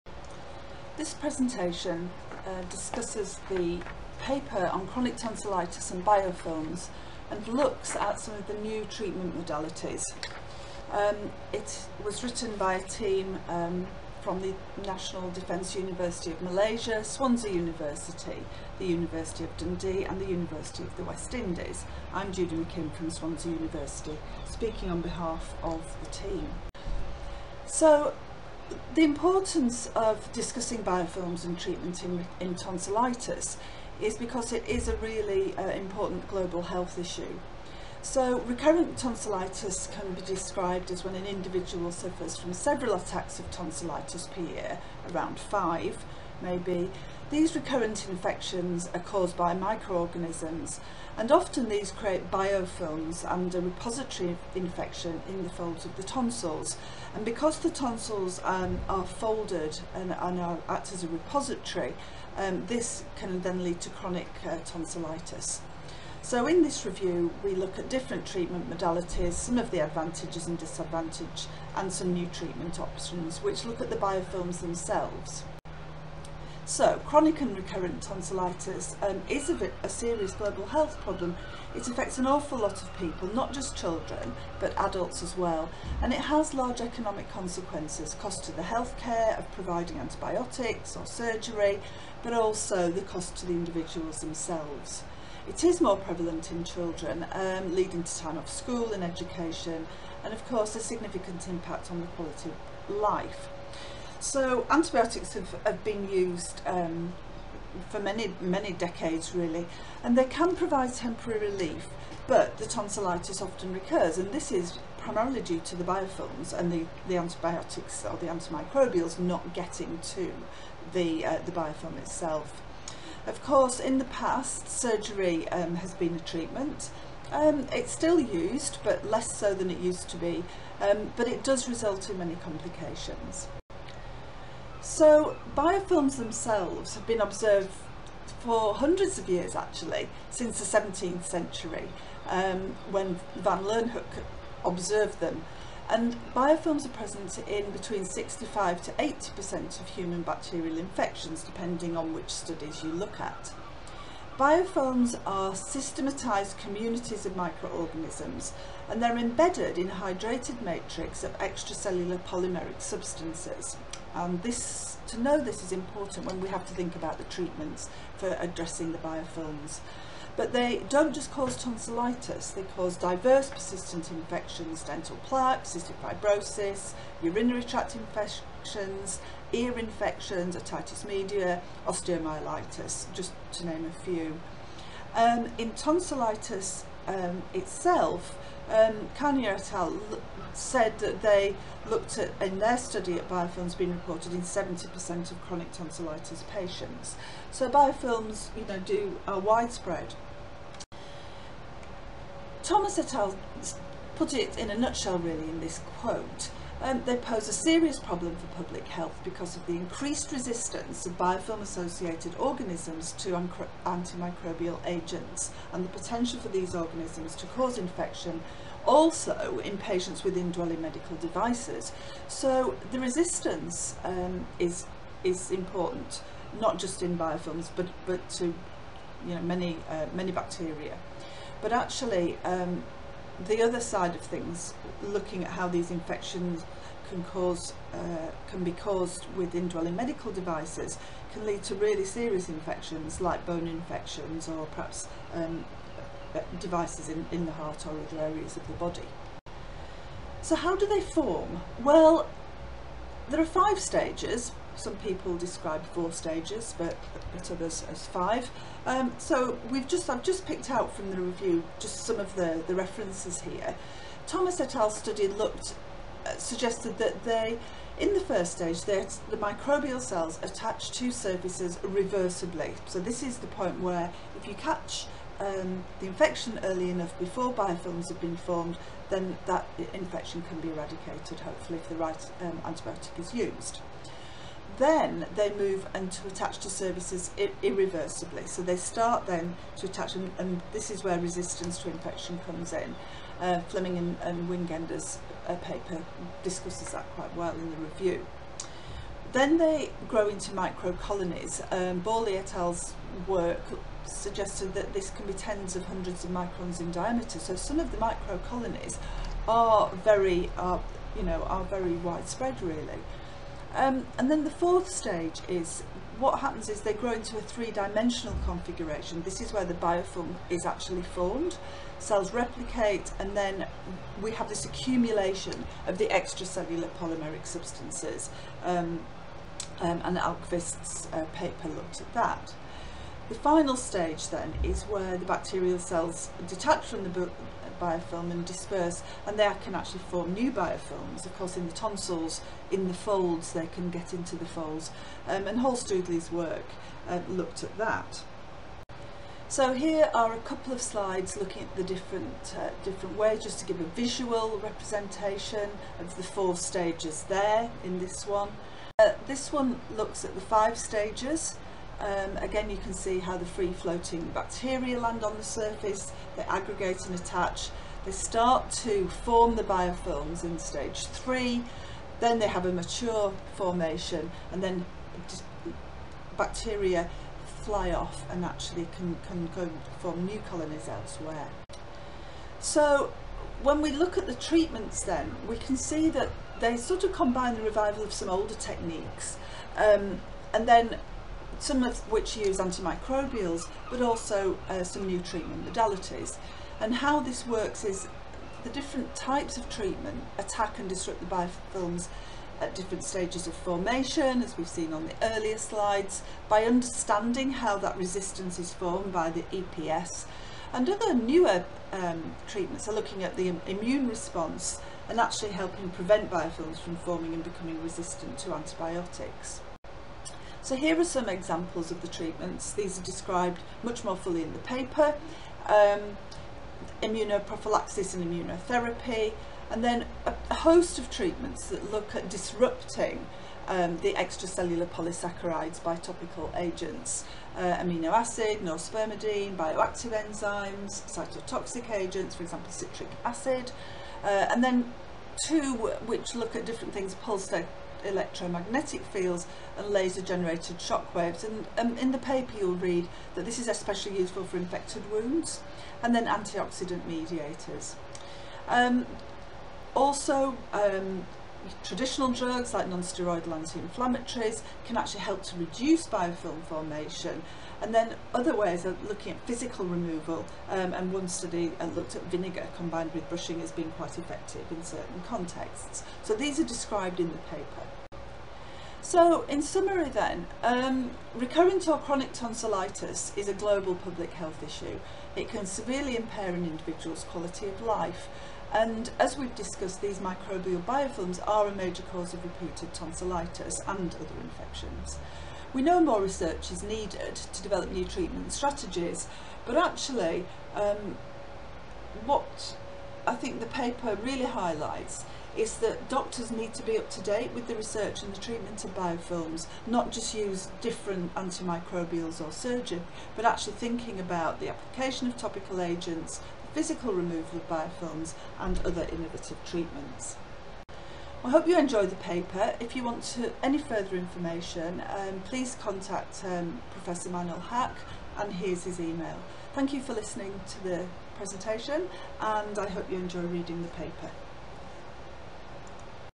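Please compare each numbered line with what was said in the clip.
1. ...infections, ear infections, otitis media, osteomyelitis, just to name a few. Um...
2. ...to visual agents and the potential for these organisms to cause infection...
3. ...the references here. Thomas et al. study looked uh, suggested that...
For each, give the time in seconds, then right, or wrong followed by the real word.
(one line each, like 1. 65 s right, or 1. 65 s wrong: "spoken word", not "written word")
1. 177 s right
2. 213 s wrong: "antimicrobial", not "visual"
3. 262 s right.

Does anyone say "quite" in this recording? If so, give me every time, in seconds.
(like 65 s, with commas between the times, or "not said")
297 s, 473 s.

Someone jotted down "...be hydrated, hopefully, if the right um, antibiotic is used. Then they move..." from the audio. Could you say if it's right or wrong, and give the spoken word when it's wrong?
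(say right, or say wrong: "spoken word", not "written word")
wrong: "eradicated", not "hydrated".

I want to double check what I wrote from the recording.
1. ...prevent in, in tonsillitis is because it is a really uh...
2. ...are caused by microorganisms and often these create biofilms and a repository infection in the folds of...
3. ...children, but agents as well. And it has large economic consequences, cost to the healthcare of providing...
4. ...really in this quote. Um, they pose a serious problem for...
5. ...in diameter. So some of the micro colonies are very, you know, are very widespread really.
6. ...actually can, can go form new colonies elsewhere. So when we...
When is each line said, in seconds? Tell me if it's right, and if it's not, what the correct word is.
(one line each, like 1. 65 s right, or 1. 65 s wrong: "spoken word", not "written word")
1. 31 s wrong: "treatment", not "prevent"
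2. 48 s right
3. 83 s wrong: "adults", not "agents"
4. 205 s right
5. 306 s right
6. 378 s right.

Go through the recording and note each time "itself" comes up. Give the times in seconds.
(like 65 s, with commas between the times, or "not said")
121 s, 187 s.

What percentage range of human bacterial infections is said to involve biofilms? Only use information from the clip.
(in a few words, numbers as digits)
65 to 80%.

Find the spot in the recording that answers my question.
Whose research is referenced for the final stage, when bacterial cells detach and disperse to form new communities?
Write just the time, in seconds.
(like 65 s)
345 s.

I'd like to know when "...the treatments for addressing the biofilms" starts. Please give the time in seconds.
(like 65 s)
167 s.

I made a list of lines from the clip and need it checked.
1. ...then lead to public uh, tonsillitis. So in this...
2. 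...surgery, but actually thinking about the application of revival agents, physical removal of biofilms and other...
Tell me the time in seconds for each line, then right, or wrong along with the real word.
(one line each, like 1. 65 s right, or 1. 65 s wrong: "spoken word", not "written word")
1. 63 s wrong: "chronic", not "public"
2. 512 s wrong: "topical", not "revival".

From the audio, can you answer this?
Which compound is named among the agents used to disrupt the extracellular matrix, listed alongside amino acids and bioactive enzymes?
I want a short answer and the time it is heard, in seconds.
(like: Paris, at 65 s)
norspermidine, at 438 s.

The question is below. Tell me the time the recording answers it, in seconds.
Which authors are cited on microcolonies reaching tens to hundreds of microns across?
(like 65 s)
302 s.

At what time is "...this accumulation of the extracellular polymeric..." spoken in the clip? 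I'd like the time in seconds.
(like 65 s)
324 s.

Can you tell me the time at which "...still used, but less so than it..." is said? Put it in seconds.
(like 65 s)
127 s.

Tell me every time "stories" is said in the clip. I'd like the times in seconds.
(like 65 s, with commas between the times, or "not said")
not said.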